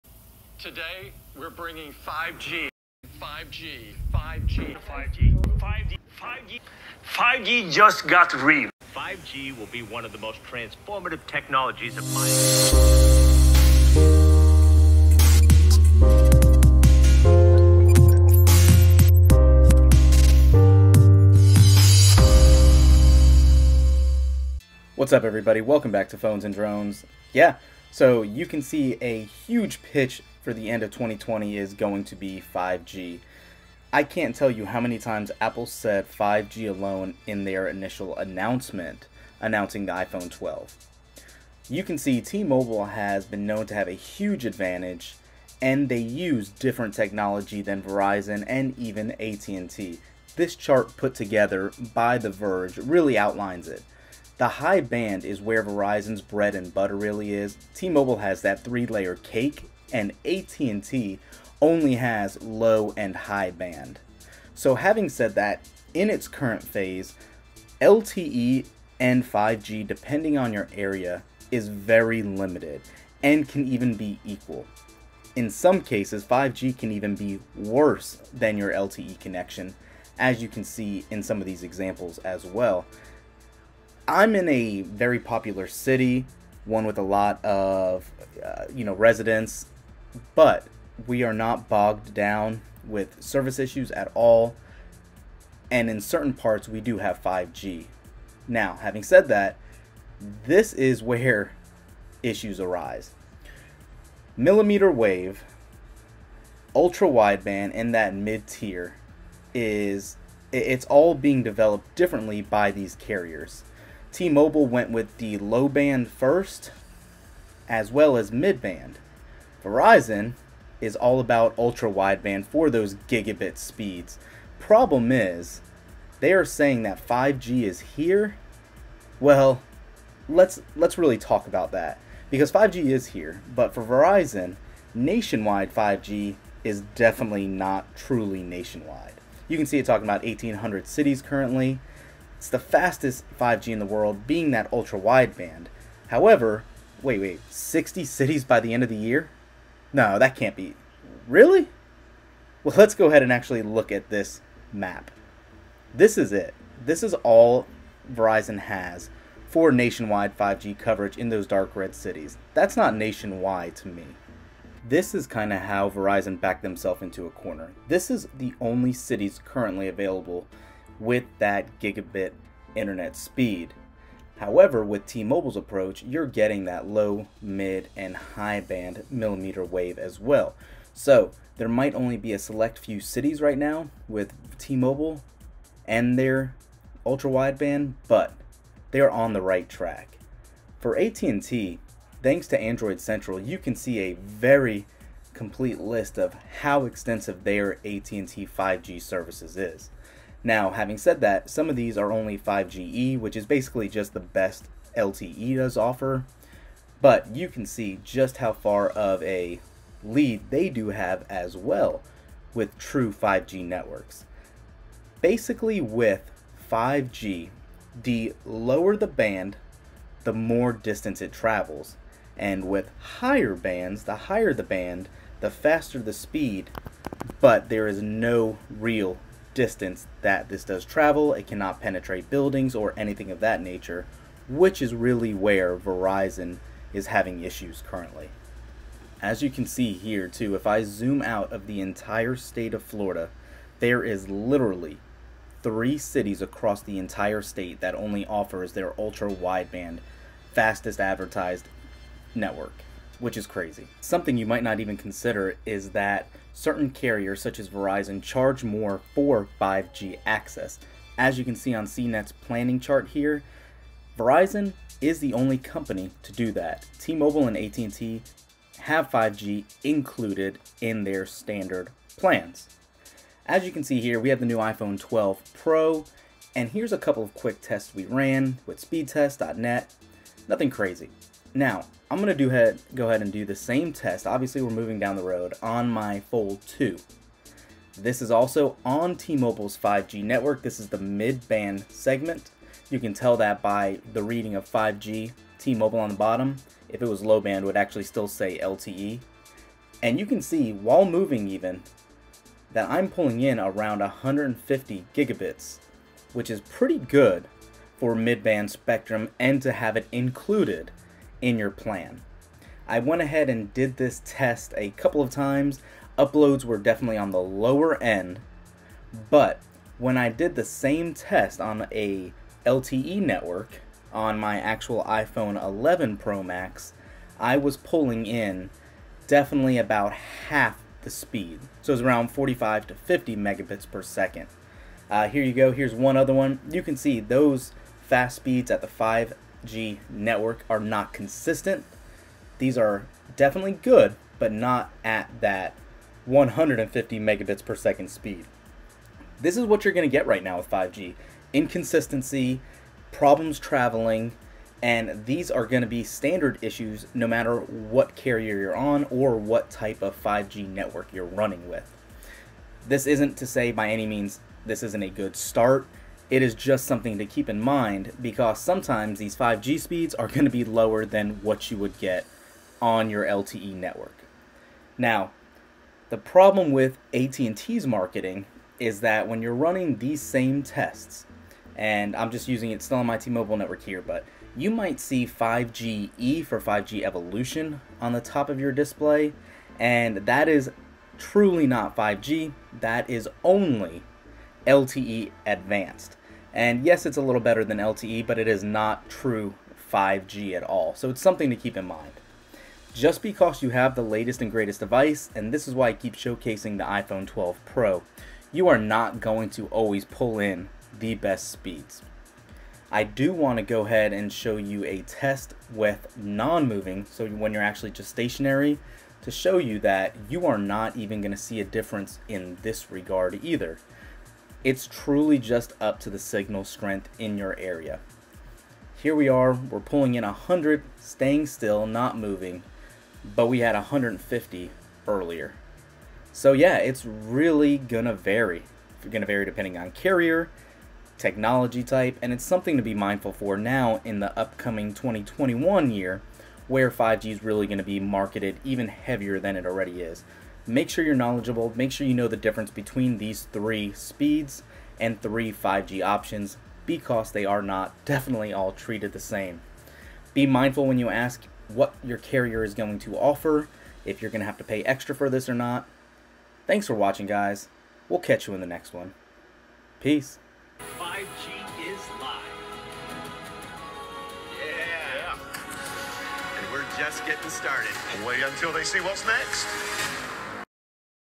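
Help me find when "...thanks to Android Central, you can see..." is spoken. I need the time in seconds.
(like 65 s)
192 s.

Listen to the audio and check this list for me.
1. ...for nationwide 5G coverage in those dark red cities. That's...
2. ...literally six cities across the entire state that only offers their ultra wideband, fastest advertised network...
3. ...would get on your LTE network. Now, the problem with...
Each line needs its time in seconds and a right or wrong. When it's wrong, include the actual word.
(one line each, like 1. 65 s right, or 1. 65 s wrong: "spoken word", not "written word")
1. 159 s right
2. 244 s wrong: "three", not "six"
3. 371 s right.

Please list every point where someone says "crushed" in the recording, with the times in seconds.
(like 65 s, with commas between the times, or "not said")
not said.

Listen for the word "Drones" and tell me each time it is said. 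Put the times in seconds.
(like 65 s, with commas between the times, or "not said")
26 s.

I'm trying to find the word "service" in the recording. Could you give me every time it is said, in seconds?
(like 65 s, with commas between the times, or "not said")
93 s, 198 s.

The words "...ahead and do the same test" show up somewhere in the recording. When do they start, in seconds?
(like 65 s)
283 s.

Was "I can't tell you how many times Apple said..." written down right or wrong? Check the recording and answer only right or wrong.
right.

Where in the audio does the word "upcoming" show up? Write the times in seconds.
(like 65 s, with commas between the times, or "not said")
444 s.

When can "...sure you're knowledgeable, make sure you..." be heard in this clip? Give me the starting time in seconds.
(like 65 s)
450 s.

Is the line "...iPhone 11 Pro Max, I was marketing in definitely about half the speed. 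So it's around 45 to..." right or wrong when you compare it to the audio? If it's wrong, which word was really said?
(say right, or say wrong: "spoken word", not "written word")
wrong: "pulling", not "marketing".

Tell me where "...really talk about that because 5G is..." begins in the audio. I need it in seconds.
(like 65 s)
130 s.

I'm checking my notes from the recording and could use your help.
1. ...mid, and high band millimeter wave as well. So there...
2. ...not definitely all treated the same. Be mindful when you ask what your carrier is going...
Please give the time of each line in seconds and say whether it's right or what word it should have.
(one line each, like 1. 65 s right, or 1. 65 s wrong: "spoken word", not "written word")
1. 177 s right
2. 457 s right.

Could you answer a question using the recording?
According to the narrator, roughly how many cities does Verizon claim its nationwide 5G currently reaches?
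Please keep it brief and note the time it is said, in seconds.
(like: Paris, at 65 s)
1800, at 140 s.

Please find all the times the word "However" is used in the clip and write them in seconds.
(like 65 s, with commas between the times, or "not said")
146 s, 174 s.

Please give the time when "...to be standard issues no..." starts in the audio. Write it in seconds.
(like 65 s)
355 s.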